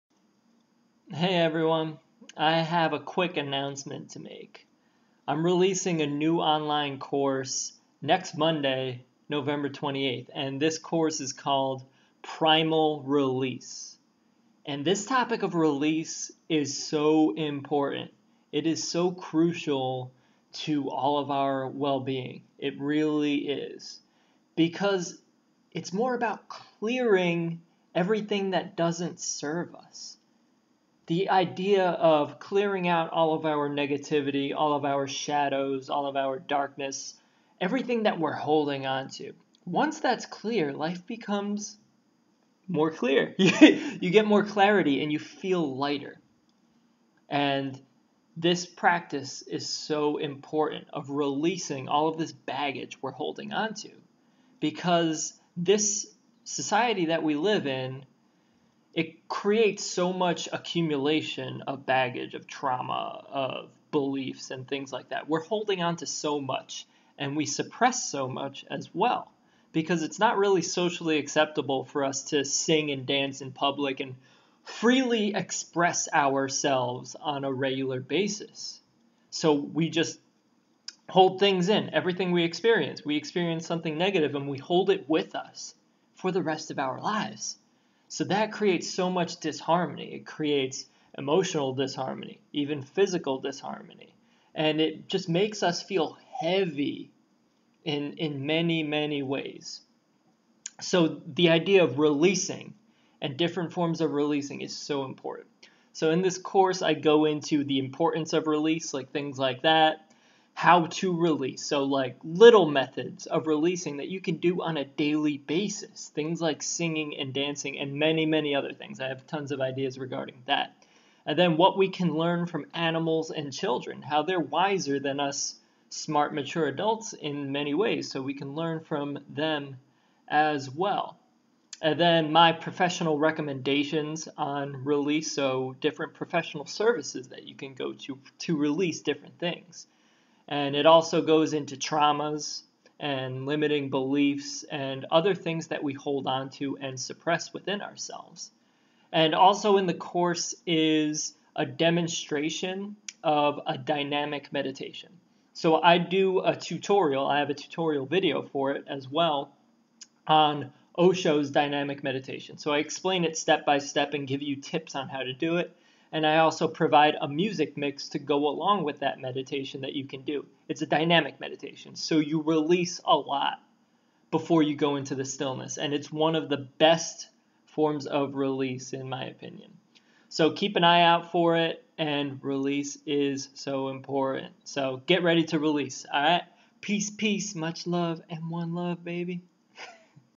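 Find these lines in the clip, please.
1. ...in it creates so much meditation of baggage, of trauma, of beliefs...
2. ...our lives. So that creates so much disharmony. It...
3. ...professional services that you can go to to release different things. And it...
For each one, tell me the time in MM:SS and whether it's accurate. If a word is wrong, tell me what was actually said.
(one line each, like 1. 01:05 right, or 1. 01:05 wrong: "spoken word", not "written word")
1. 00:57 wrong: "accumulation", not "meditation"
2. 01:26 right
3. 02:16 right.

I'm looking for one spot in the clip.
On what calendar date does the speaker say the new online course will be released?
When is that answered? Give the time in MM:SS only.
00:09.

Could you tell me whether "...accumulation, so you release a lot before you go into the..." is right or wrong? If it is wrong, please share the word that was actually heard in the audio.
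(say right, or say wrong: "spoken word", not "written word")
wrong: "meditation", not "accumulation".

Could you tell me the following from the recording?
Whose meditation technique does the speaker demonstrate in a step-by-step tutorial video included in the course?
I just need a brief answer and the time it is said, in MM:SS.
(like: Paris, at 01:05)
Osho, at 02:40.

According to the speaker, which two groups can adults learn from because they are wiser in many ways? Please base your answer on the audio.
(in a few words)
animals and children.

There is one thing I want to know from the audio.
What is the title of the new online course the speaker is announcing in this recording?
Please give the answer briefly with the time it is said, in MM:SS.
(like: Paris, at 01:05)
Primal Release, at 00:12.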